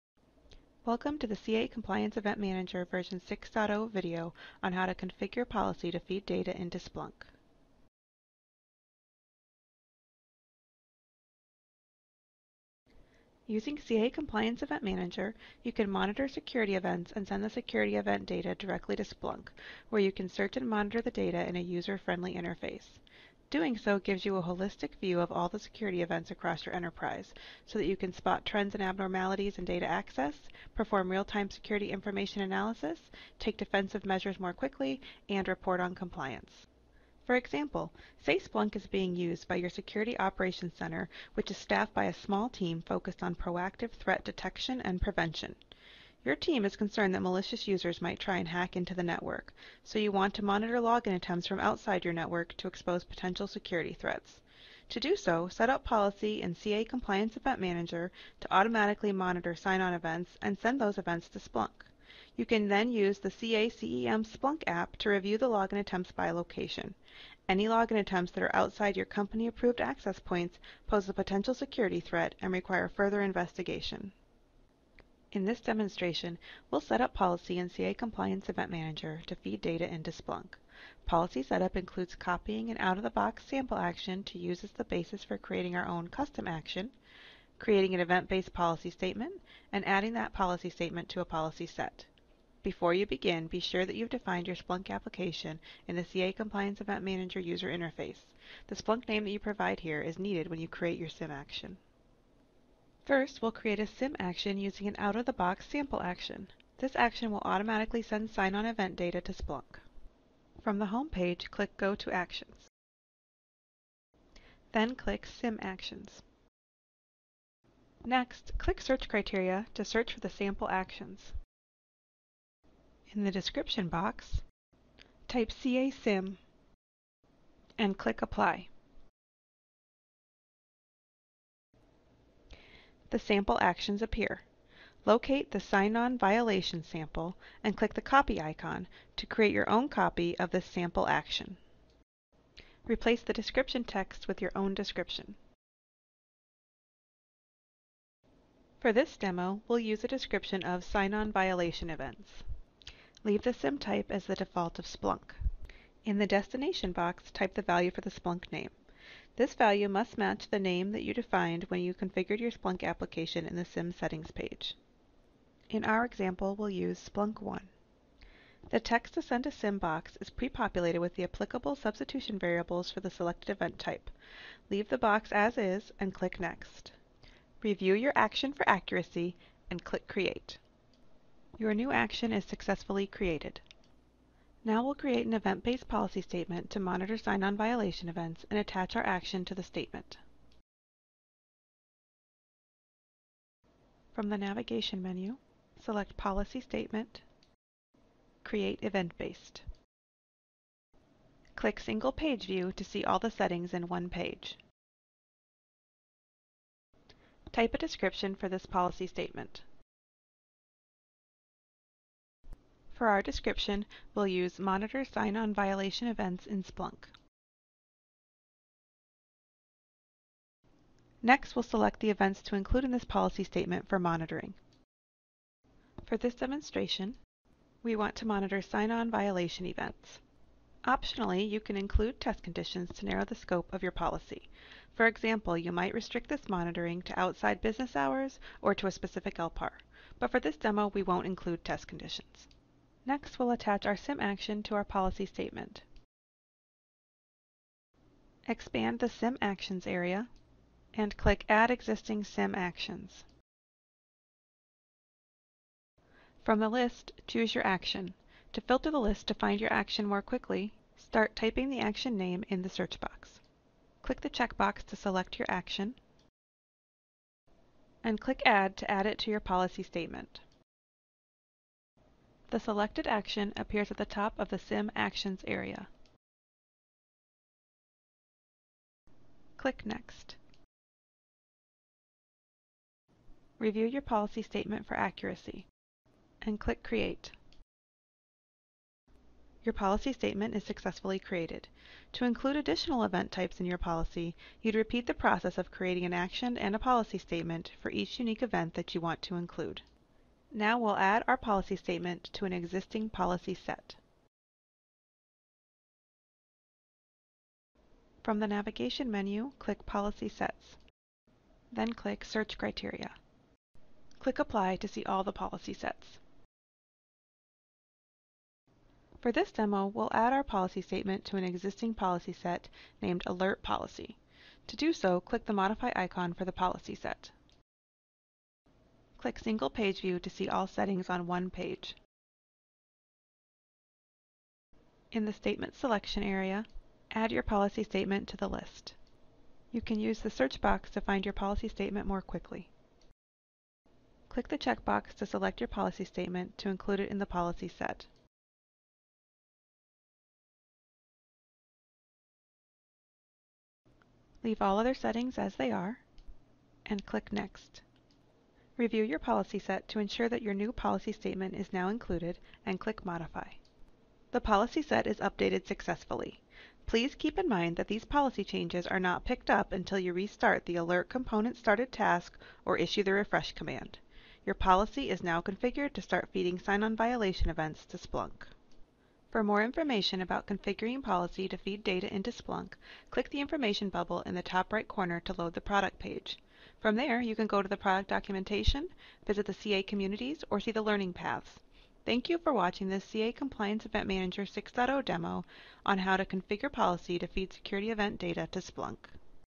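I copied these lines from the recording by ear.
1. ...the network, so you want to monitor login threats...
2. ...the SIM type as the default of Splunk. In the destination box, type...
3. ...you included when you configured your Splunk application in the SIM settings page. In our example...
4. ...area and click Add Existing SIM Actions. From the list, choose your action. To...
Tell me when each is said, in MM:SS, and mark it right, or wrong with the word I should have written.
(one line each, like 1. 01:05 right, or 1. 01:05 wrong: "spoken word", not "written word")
1. 00:48 wrong: "attempts", not "threats"
2. 02:33 right
3. 02:41 wrong: "defined", not "included"
4. 04:09 right.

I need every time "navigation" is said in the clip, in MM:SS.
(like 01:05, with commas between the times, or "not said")
03:14, 05:08.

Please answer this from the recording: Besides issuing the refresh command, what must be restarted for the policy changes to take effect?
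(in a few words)
Alert Component Started task.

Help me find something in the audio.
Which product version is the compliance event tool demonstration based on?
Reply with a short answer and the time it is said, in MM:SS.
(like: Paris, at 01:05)
6.0, at 00:02.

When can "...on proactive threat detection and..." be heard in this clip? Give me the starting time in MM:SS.
00:43.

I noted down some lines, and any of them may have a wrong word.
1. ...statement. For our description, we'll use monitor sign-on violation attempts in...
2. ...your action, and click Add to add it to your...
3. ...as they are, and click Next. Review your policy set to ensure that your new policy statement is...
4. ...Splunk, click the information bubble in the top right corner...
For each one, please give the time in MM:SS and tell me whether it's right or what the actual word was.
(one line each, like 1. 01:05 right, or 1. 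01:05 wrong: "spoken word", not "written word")
1. 03:29 wrong: "events", not "attempts"
2. 04:25 right
3. 05:55 right
4. 06:22 right.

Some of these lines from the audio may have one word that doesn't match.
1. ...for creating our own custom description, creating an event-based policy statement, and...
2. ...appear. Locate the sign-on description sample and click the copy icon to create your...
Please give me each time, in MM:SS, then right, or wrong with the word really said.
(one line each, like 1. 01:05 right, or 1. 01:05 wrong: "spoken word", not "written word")
1. 01:25 wrong: "action", not "description"
2. 02:14 wrong: "violation", not "description".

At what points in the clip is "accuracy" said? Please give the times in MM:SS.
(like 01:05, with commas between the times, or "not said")
02:58, 04:44.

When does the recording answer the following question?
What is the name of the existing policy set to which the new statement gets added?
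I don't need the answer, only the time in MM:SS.
05:23.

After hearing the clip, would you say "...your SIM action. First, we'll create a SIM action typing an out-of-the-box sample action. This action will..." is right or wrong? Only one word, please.
wrong.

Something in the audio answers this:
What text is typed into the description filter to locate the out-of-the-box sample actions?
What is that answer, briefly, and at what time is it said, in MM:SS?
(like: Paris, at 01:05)
CA SIM, at 02:05.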